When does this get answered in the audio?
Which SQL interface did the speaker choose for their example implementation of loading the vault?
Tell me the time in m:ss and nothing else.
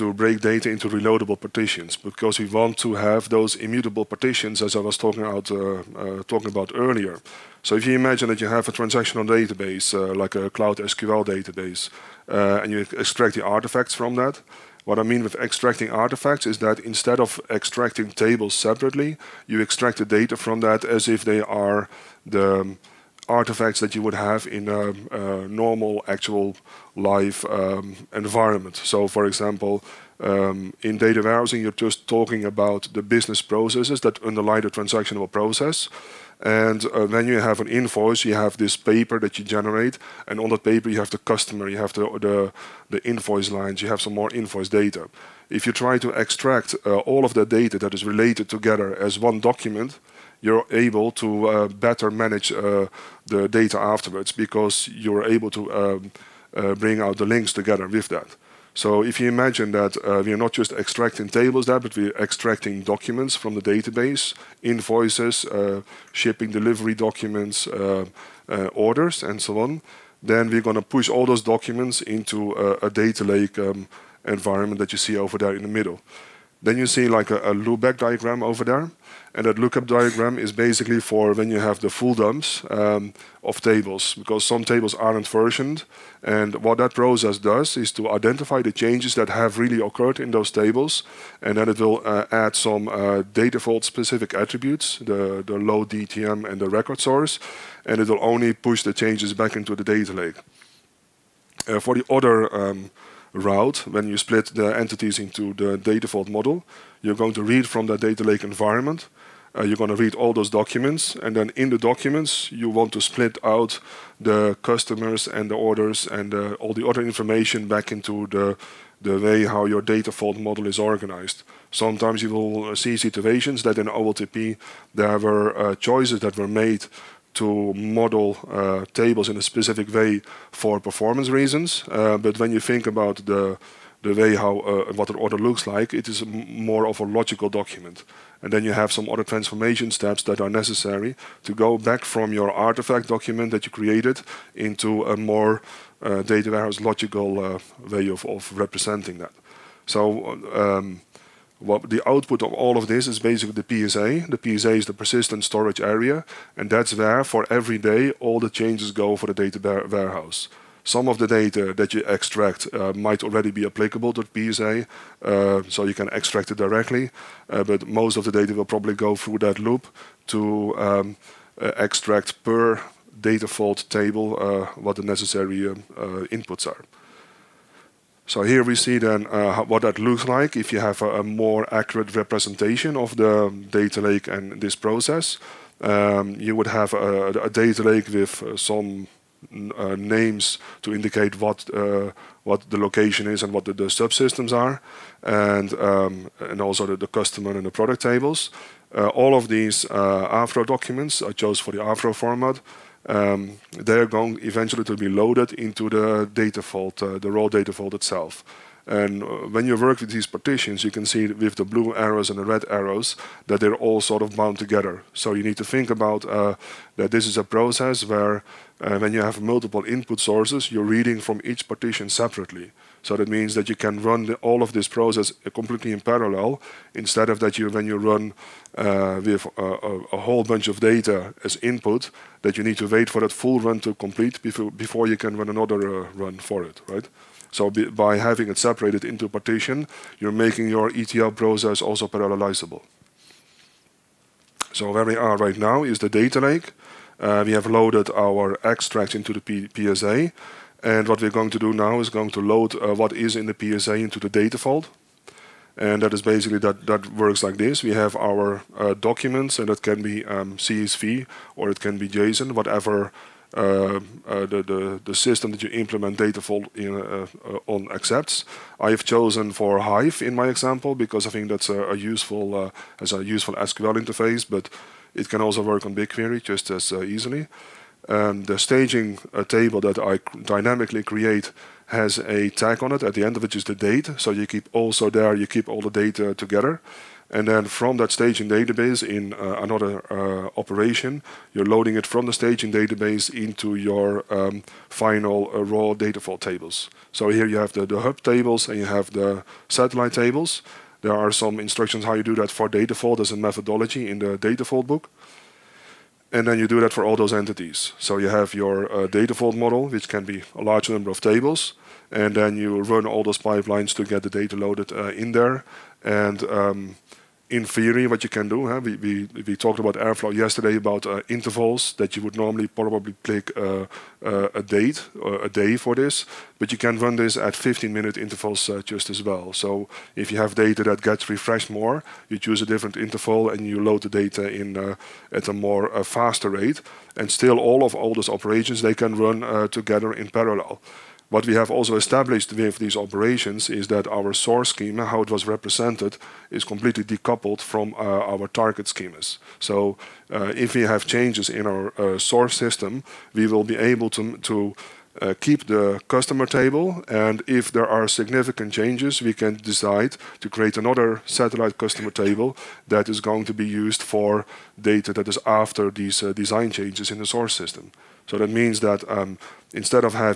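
4:29.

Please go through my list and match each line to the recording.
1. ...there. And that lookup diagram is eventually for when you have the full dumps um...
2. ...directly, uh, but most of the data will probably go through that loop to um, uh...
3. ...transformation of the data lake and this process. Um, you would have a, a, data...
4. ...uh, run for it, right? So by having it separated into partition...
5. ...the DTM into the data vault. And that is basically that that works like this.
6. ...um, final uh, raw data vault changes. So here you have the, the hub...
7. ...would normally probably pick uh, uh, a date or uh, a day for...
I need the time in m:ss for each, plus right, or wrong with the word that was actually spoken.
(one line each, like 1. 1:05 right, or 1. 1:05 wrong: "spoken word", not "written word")
1. 1:18 wrong: "basically", not "eventually"
2. 2:46 right
3. 3:02 wrong: "representation", not "transformation"
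4. 3:56 right
5. 4:13 wrong: "PSA", not "DTM"
6. 4:54 wrong: "tables", not "changes"
7. 5:22 right.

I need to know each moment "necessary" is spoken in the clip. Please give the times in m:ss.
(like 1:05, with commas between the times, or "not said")
2:20, 2:55.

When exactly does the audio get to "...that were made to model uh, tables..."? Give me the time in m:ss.
2:06.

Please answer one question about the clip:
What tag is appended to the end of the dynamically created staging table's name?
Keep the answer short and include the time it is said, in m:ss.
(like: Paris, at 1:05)
The date, at 4:43.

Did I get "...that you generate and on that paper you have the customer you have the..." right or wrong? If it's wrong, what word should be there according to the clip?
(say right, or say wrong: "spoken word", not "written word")
right.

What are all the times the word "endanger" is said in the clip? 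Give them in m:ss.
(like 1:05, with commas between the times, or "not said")
not said.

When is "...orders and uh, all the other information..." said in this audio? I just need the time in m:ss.
1:55.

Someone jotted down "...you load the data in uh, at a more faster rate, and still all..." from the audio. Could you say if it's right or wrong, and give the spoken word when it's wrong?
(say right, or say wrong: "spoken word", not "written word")
right.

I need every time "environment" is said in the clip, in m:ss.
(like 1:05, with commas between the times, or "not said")
0:28, 1:14, 1:48.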